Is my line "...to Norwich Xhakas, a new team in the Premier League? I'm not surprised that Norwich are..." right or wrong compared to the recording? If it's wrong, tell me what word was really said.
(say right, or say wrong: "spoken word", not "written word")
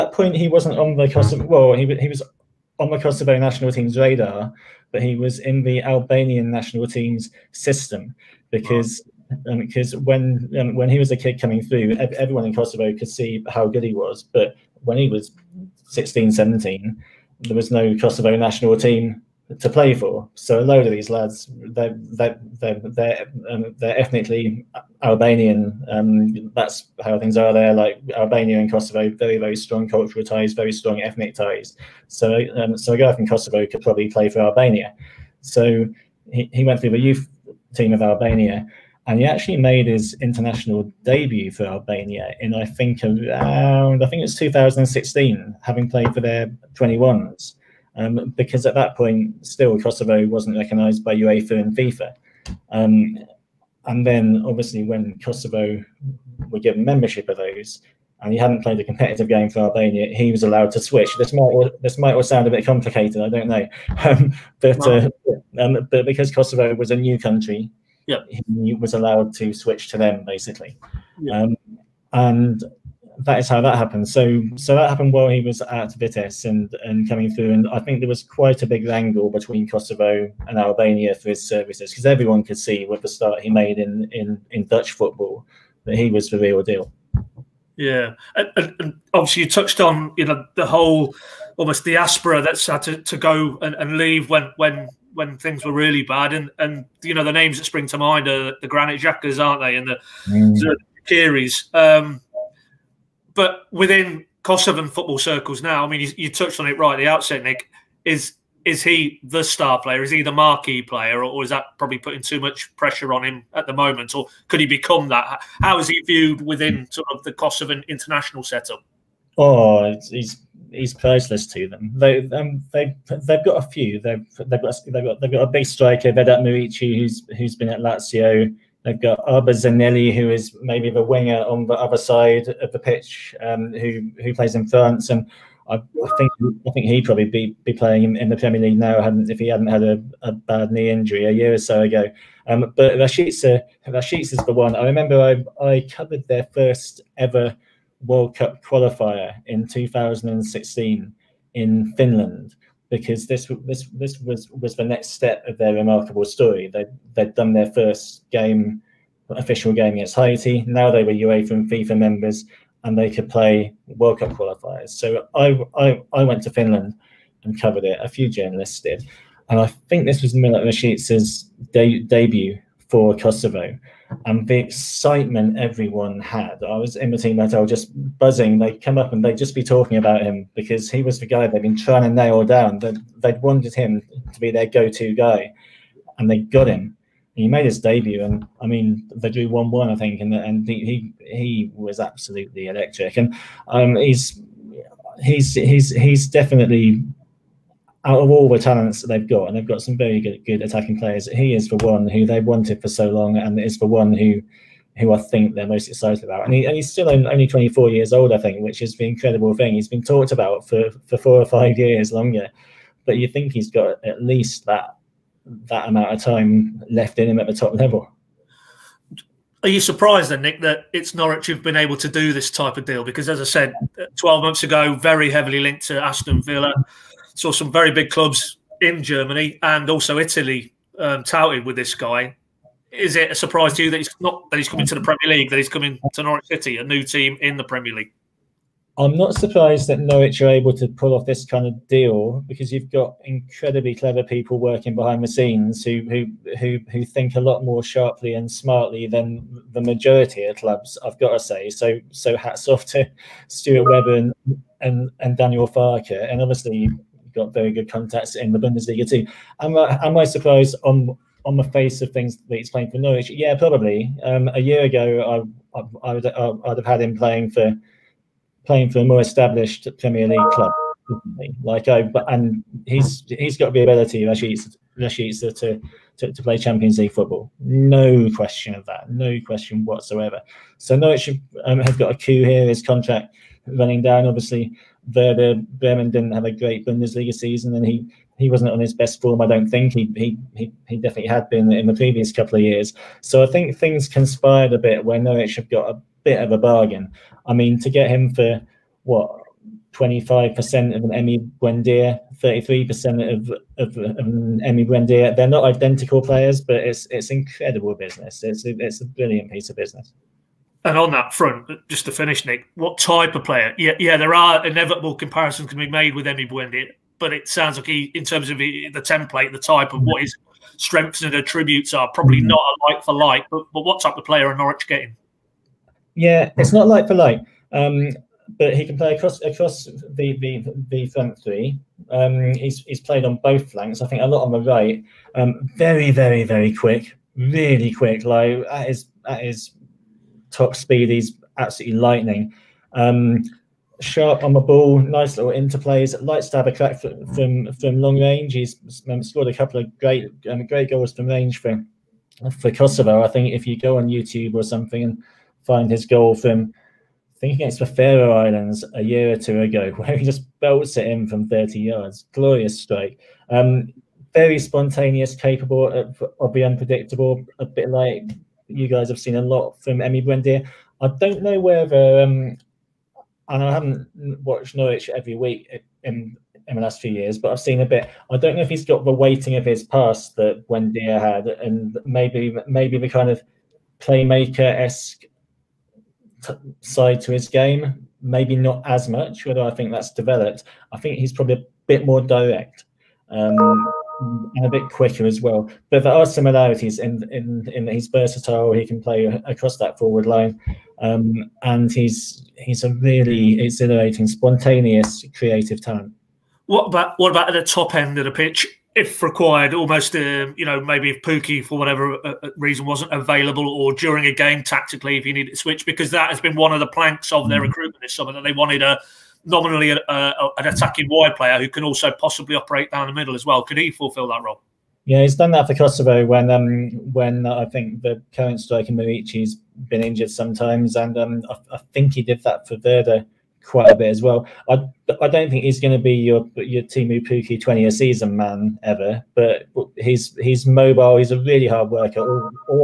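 wrong: "City", not "Xhakas".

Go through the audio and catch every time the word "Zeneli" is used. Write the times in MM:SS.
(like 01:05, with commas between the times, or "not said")
02:09.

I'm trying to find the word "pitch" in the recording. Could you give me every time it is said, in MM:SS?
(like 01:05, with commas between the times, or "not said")
02:12, 06:48.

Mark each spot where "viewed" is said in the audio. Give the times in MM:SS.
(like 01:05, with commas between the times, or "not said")
01:56.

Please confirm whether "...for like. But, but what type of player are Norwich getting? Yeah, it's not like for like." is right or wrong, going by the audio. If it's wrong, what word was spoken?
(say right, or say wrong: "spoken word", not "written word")
right.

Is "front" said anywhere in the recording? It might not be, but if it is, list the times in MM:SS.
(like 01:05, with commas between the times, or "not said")
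05:11, 05:31.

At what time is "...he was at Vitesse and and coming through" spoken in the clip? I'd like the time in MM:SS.
01:15.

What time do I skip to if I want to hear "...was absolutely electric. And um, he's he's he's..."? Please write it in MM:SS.
03:11.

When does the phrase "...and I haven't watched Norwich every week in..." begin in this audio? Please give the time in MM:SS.
06:13.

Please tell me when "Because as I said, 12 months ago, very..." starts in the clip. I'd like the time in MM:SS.
03:43.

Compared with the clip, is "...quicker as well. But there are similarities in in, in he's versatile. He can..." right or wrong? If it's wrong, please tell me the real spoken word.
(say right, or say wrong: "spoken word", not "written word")
right.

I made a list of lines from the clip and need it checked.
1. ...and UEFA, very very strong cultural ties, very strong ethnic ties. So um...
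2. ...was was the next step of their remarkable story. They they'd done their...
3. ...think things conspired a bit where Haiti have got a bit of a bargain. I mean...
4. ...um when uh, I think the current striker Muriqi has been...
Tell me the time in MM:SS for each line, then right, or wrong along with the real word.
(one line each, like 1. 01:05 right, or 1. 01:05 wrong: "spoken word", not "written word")
1. 00:28 wrong: "Kosovo", not "UEFA"
2. 02:34 right
3. 04:53 wrong: "Norwich", not "Haiti"
4. 07:06 right.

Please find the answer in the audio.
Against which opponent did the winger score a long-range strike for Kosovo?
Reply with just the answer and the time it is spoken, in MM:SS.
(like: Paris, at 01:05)
Faroe Islands, at 05:57.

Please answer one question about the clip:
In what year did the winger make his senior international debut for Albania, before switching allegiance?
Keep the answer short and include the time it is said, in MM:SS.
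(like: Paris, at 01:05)
2016, at 00:44.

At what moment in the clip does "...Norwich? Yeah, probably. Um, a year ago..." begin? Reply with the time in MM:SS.
04:22.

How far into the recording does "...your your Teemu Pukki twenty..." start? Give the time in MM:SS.
07:16.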